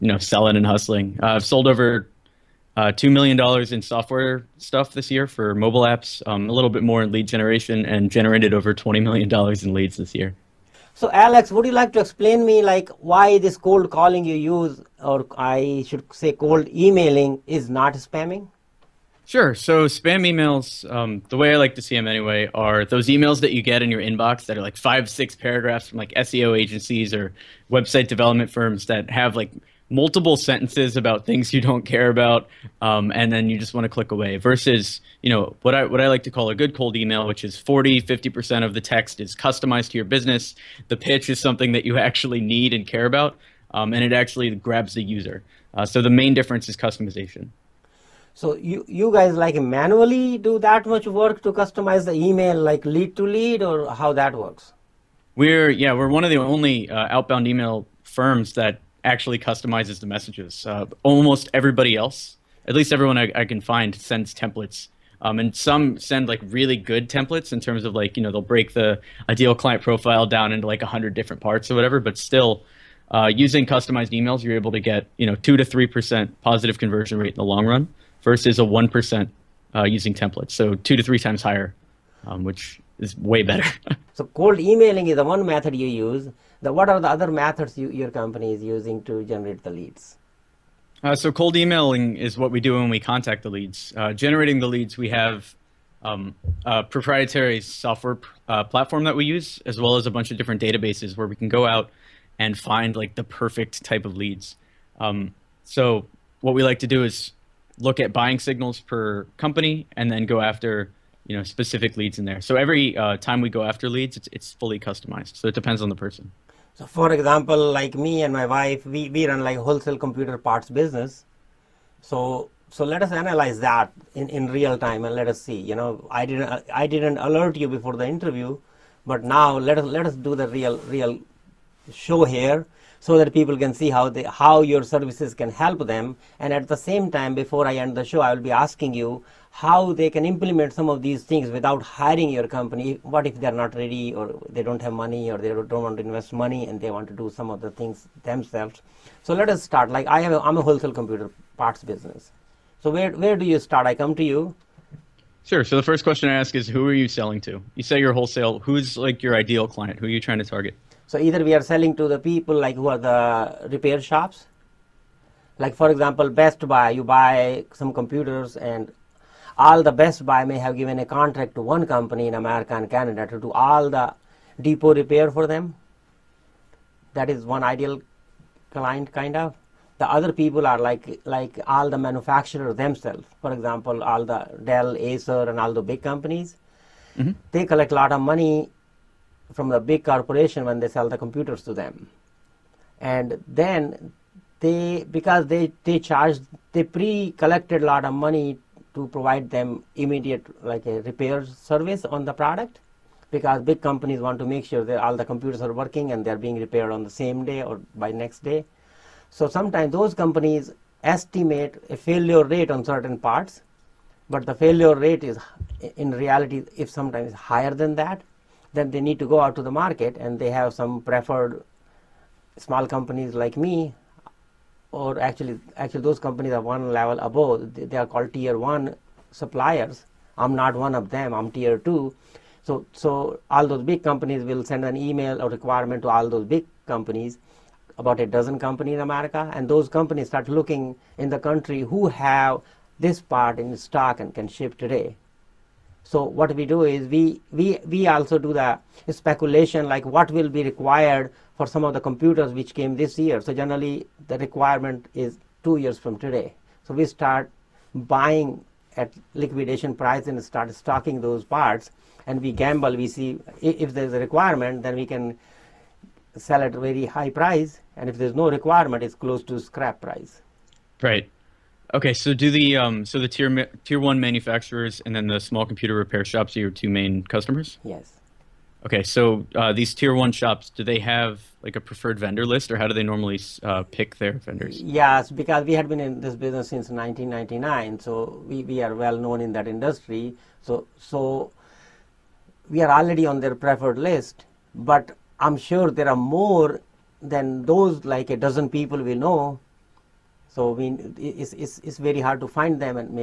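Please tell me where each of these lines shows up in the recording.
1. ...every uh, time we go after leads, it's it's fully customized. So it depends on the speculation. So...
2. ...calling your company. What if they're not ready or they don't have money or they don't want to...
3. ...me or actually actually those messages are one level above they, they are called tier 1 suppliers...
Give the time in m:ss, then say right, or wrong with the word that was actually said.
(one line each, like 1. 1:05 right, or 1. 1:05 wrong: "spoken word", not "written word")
1. 1:52 wrong: "person", not "speculation"
2. 2:21 wrong: "hiring", not "calling"
3. 3:43 wrong: "companies", not "messages".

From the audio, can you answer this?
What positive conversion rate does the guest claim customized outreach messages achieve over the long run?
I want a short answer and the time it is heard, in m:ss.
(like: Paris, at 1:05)
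2 to 3 percent, at 1:15.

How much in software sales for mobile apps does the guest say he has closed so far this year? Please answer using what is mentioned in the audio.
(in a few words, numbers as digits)
$2 million.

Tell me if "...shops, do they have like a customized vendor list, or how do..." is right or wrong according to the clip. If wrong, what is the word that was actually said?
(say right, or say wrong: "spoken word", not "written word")
wrong: "preferred", not "customized".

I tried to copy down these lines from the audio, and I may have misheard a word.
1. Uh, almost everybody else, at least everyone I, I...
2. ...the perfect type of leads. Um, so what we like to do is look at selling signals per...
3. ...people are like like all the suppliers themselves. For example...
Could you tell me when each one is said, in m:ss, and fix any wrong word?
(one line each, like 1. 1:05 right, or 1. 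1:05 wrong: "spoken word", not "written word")
1. 1:00 right
2. 1:43 wrong: "buying", not "selling"
3. 3:00 wrong: "manufacturers", not "suppliers".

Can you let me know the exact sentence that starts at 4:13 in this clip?
So generally the requirement is two years from today.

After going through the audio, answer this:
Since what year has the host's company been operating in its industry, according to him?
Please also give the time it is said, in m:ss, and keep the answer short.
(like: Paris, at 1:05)
1999, at 4:46.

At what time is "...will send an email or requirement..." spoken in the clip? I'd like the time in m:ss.
3:54.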